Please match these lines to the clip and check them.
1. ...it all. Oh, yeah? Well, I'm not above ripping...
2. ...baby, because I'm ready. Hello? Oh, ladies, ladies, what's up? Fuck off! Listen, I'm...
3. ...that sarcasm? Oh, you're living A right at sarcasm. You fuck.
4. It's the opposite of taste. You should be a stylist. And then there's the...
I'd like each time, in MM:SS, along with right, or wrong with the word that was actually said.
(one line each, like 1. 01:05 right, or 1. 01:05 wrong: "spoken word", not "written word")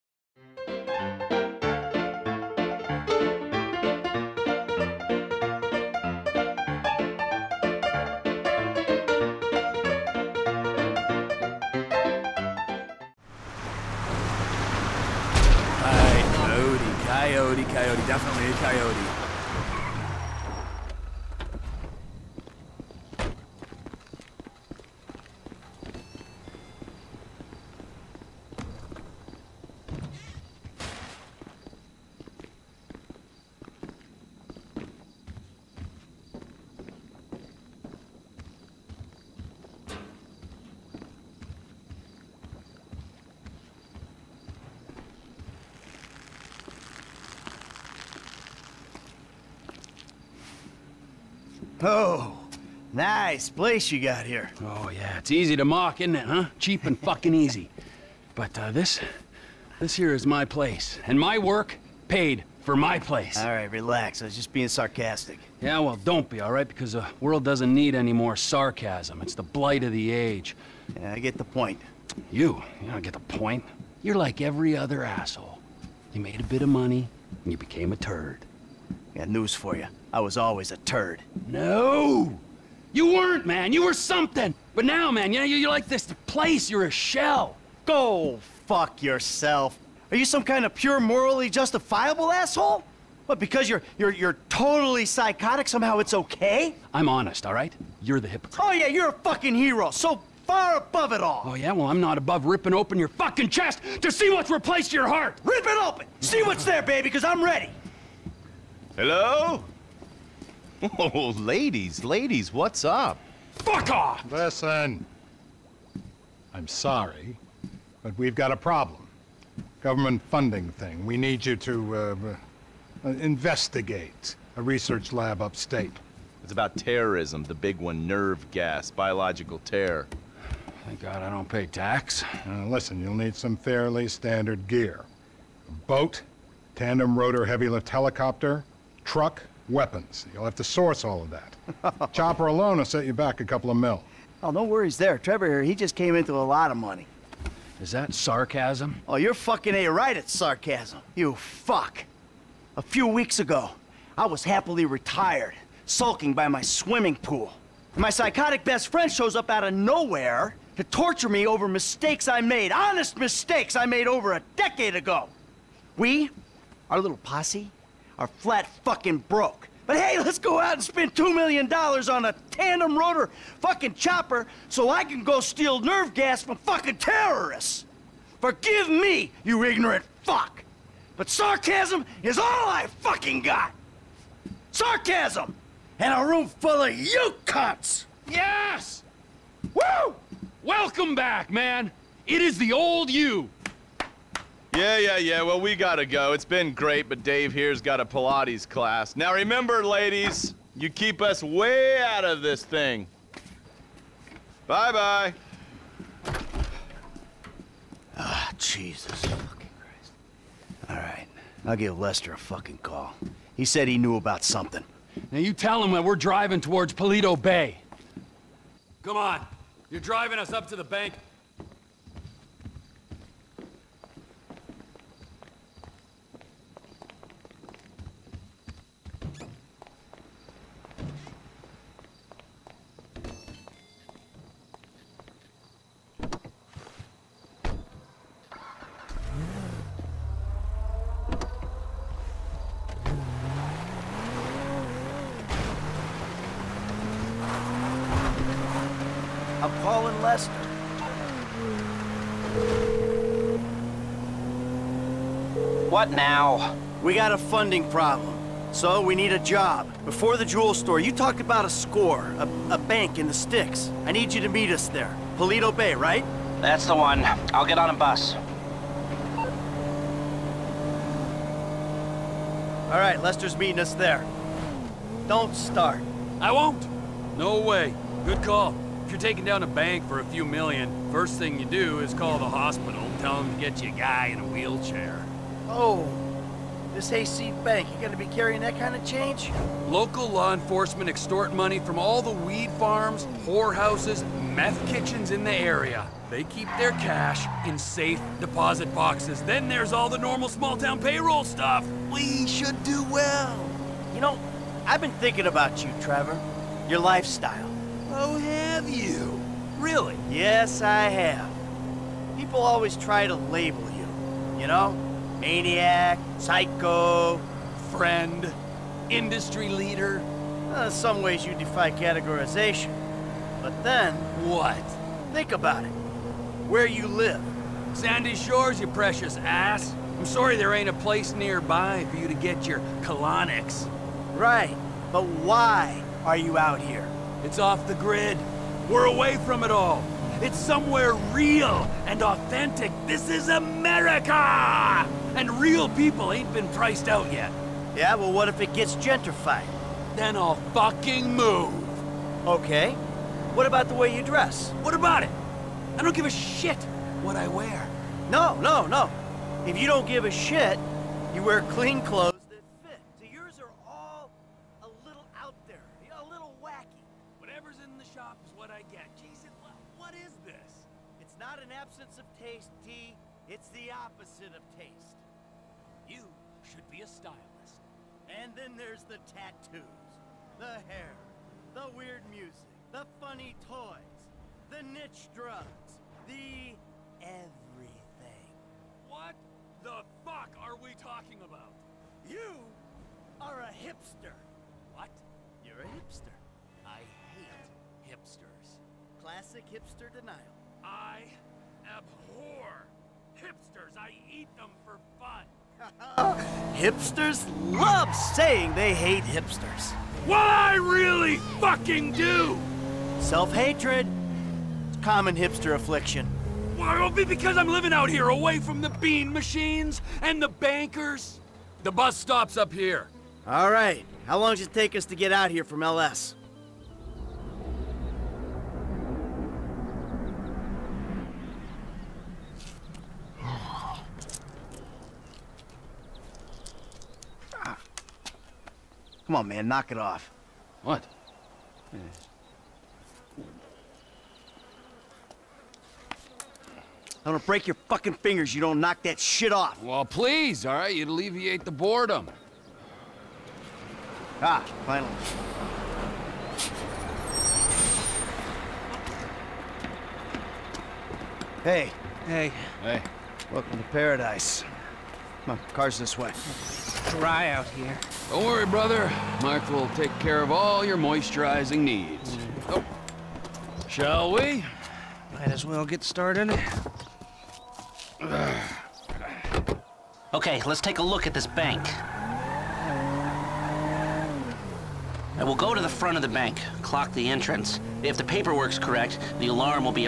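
1. 01:41 right
2. 01:46 right
3. 02:27 wrong: "fucking", not "living"
4. 06:13 right.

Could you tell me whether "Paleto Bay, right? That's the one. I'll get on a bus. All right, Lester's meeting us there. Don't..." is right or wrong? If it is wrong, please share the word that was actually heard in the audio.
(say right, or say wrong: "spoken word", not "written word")
right.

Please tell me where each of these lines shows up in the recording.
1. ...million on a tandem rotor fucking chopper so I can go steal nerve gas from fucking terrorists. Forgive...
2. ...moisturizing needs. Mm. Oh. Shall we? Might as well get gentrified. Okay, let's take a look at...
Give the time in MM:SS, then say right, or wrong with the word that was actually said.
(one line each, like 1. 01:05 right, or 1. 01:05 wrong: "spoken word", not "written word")
1. 02:51 right
2. 07:50 wrong: "started", not "gentrified".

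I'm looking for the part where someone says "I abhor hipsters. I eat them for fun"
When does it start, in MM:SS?
06:40.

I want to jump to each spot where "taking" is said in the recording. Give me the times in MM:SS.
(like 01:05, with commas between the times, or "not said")
04:39.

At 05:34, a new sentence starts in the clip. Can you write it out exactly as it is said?
Right, but why are you out here?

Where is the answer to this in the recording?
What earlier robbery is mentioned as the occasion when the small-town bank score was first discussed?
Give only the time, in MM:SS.
04:20.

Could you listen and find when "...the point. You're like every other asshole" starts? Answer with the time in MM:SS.
01:13.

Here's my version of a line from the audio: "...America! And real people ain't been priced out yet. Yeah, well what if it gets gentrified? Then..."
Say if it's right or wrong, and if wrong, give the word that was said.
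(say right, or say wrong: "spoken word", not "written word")
right.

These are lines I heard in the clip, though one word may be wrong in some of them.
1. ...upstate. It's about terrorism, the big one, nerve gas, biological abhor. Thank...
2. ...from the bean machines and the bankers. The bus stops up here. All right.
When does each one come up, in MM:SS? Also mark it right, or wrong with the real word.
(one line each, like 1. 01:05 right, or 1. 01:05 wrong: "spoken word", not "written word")
1. 02:05 wrong: "terror", not "abhor"
2. 06:58 right.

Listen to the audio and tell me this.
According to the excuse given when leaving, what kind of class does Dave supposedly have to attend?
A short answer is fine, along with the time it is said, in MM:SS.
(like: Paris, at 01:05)
Pilates, at 03:18.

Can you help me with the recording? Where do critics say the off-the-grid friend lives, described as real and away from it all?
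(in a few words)
Sandy Shores.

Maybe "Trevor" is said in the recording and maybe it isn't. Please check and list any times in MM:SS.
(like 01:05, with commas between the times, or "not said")
02:25, 05:06.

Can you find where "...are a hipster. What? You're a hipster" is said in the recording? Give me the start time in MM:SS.
06:33.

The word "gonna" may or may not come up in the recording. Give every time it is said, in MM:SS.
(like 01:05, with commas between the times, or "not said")
04:48, 07:27.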